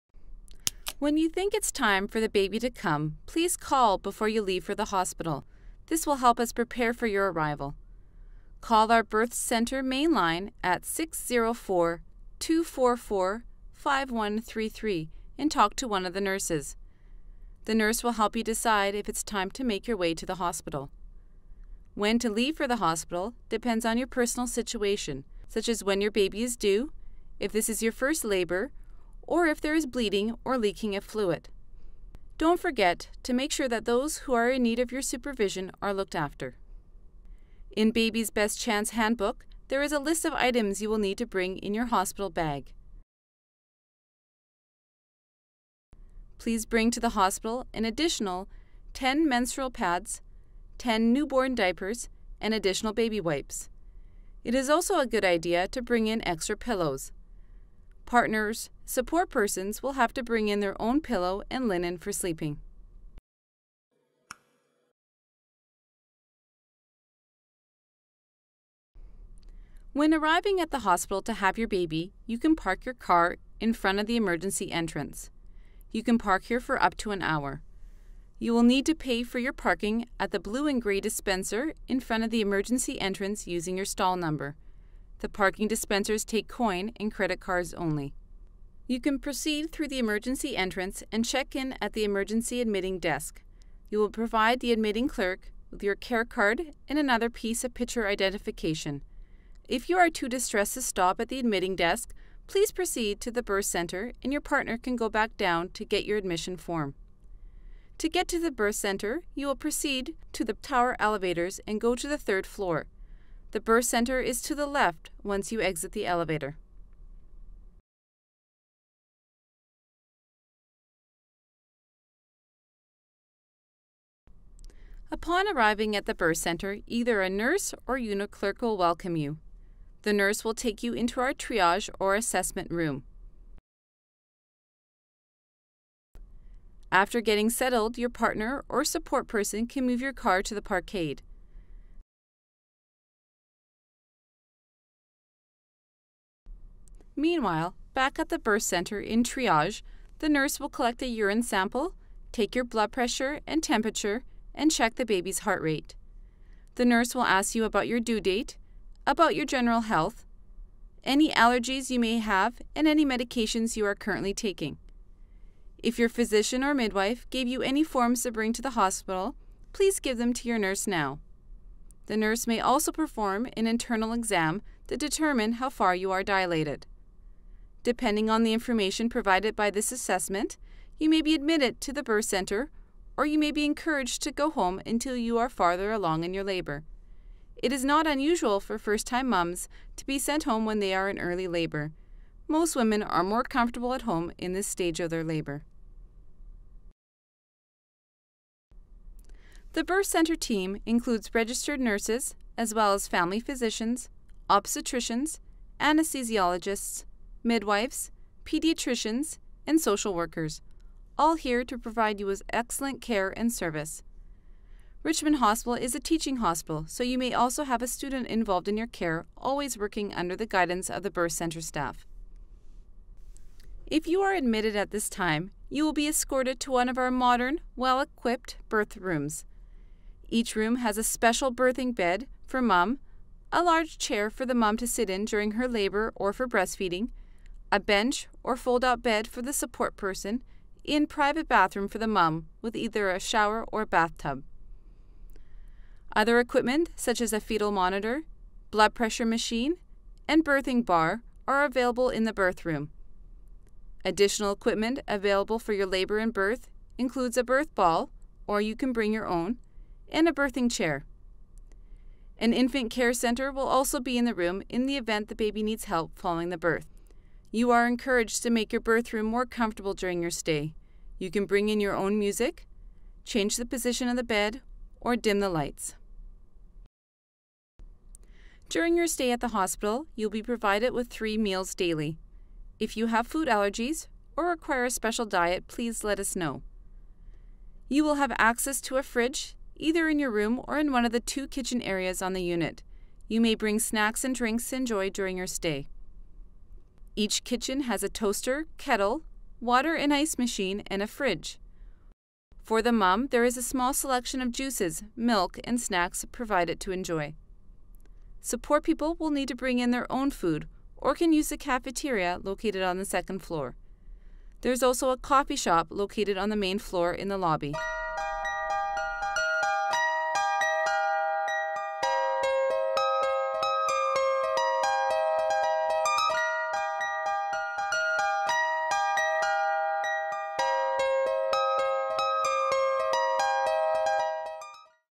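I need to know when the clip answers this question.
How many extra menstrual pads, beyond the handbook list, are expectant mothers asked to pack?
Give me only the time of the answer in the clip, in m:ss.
0:48.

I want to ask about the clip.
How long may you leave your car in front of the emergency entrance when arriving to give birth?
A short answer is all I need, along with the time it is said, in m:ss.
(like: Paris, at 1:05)
up to an hour, at 1:16.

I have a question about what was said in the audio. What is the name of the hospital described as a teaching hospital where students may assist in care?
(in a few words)
Richmond Hospital.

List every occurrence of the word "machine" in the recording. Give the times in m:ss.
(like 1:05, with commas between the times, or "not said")
4:09, 5:00.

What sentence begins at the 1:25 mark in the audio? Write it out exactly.
The parking dispensers take coin and credit cards only.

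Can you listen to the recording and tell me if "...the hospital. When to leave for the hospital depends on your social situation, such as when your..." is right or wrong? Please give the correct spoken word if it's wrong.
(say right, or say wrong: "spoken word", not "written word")
wrong: "personal", not "social".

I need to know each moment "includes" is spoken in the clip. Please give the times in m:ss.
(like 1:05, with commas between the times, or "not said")
3:20, 4:16.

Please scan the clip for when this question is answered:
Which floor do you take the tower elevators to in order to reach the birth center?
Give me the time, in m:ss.
1:52.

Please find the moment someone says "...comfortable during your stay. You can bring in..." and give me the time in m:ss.
4:29.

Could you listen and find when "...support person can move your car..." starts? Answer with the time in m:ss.
2:18.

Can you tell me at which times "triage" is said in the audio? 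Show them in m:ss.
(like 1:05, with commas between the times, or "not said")
2:11, 2:29.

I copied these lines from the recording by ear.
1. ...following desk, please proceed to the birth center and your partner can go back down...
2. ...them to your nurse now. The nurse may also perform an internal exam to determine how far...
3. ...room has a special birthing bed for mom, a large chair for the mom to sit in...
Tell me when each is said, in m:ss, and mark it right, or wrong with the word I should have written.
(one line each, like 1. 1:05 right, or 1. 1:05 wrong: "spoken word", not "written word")
1. 1:41 wrong: "admitting", not "following"
2. 2:50 right
3. 3:50 right.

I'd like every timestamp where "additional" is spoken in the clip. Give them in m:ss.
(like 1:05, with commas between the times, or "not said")
0:47, 0:52, 4:14.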